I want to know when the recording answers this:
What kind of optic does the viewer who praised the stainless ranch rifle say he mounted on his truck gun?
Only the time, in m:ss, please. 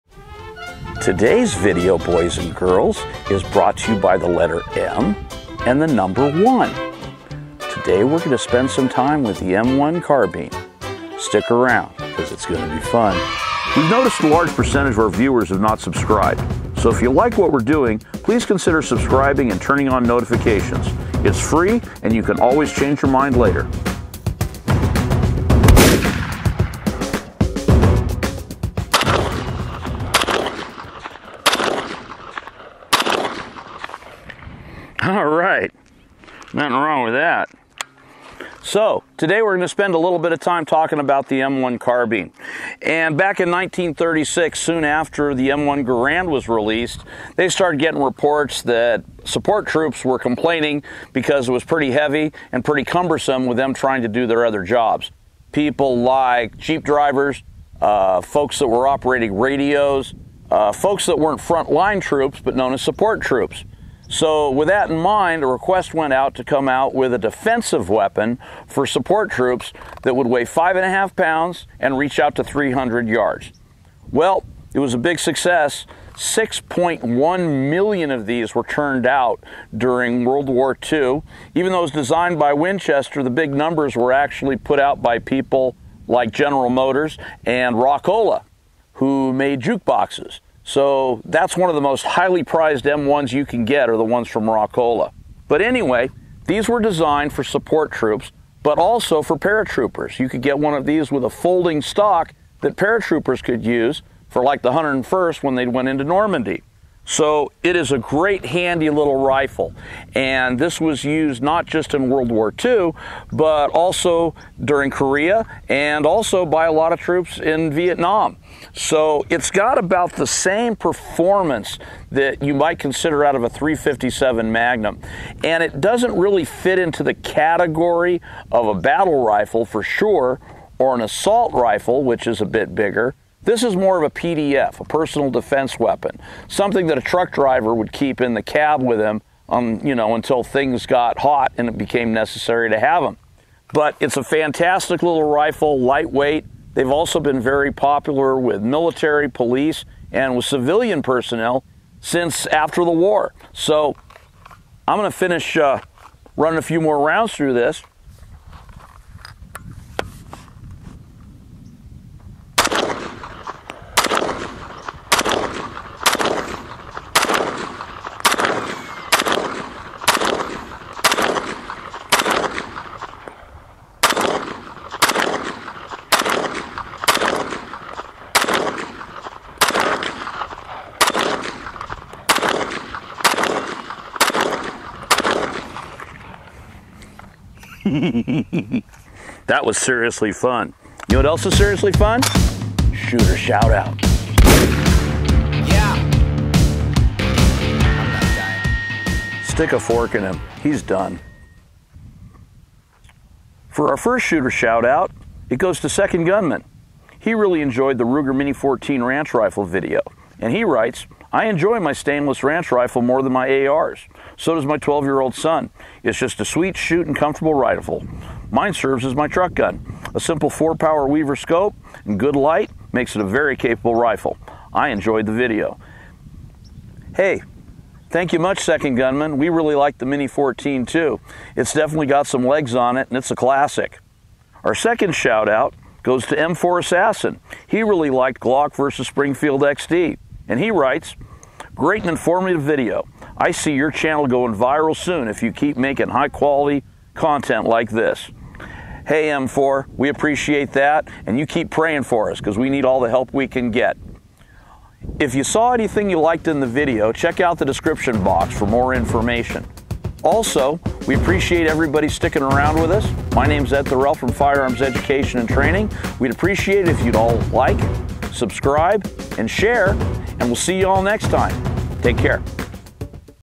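3:40.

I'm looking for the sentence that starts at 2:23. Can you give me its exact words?
But it's a fantastic little rifle, lightweight.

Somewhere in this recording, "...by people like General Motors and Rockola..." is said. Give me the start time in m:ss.
1:25.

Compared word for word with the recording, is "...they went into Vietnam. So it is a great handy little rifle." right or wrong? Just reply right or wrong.
wrong.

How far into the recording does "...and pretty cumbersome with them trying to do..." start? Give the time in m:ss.
0:52.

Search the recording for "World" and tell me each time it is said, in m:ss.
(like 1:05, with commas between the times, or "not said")
1:20, 1:52.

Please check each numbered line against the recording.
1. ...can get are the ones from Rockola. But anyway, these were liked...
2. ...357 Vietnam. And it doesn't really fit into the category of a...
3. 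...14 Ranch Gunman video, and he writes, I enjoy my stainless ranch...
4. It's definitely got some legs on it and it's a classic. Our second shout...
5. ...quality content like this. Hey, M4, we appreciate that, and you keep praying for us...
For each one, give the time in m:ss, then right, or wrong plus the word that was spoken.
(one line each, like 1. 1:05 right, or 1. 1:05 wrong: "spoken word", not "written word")
1. 1:33 wrong: "designed", not "liked"
2. 2:03 wrong: "Magnum", not "Vietnam"
3. 3:28 wrong: "Rifle", not "Gunman"
4. 3:51 right
5. 4:06 right.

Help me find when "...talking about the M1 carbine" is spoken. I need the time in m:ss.
0:40.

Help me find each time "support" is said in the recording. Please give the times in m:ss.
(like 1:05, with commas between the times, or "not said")
0:49, 1:02, 1:08, 1:37.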